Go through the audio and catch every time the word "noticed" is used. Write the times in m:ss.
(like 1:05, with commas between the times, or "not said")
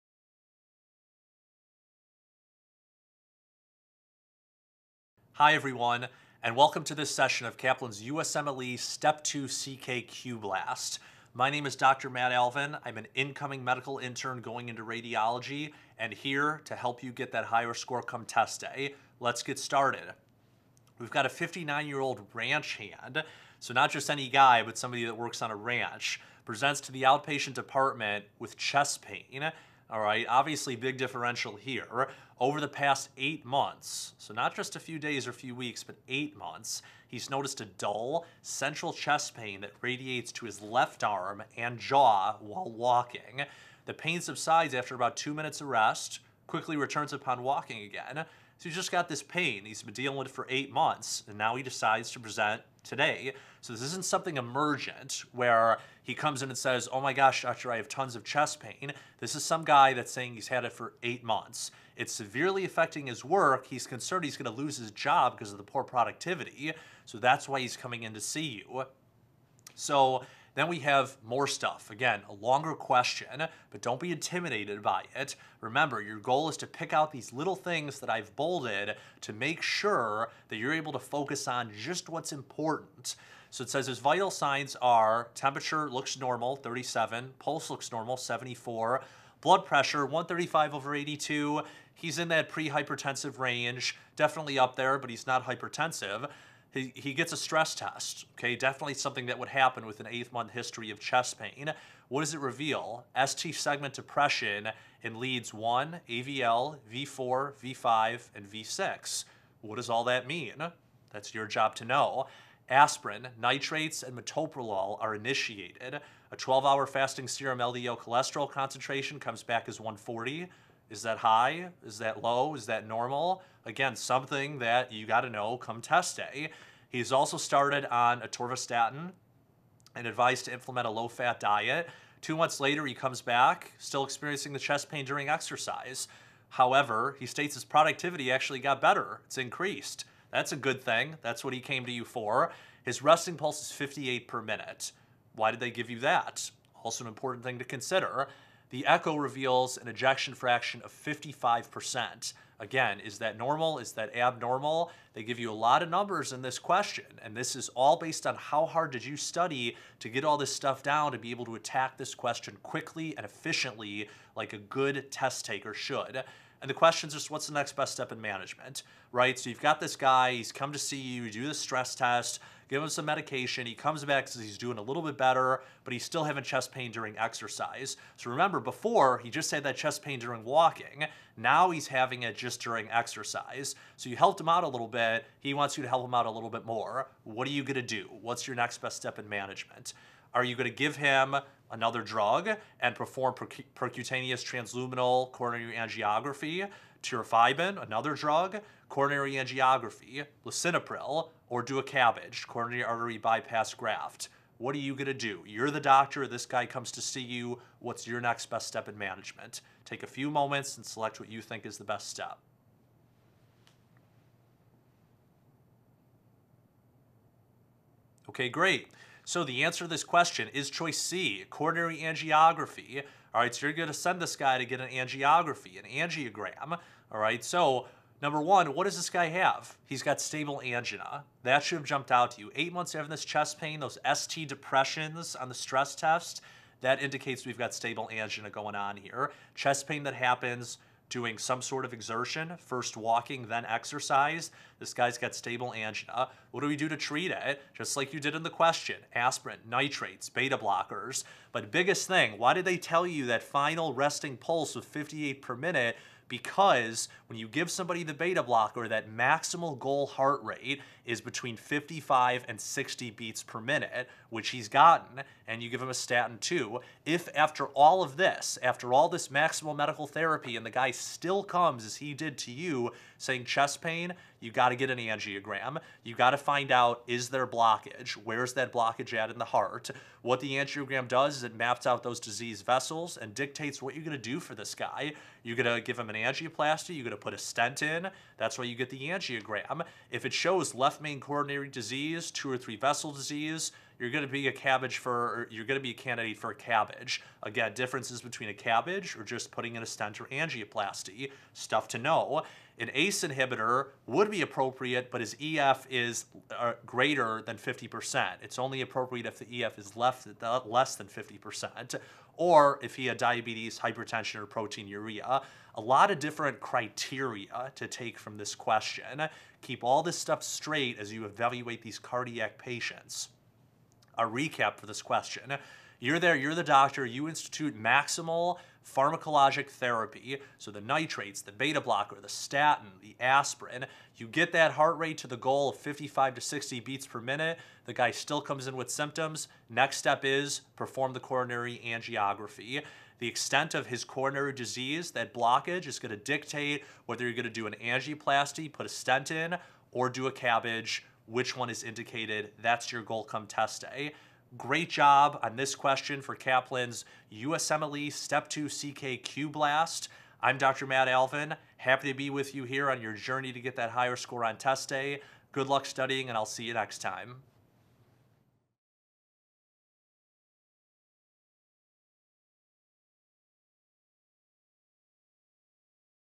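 0:37.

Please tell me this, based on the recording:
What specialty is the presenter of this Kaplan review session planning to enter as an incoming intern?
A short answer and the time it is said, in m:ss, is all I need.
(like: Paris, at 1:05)
Radiology, at 0:14.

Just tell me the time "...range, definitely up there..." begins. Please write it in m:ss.
1:33.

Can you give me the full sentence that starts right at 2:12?
Two months later, he comes back, still experiencing the chest pain during exercise.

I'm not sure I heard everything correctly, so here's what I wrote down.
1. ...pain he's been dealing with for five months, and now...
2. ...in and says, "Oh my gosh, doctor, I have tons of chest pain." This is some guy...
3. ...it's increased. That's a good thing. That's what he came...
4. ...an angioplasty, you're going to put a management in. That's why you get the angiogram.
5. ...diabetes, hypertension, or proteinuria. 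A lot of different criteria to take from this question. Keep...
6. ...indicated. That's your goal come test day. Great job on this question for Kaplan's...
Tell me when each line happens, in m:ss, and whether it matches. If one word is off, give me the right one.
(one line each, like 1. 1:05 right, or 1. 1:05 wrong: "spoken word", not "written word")
1. 0:49 wrong: "eight", not "five"
2. 0:56 right
3. 2:19 right
4. 4:46 wrong: "stent", not "management"
5. 5:13 right
6. 5:51 right.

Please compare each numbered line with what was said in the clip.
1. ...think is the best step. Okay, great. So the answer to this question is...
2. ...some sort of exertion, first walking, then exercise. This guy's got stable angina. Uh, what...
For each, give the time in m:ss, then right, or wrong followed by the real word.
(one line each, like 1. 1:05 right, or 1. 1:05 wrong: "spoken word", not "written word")
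1. 3:31 right
2. 4:01 right.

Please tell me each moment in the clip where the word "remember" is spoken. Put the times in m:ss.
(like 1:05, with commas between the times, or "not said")
1:15, 2:58.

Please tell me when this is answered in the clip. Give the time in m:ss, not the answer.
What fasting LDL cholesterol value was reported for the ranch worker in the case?
1:59.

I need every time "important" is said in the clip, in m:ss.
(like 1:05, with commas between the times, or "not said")
1:22, 2:27.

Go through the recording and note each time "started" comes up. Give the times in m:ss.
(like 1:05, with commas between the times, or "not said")
0:19, 2:07.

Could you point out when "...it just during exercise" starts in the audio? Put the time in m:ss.
3:02.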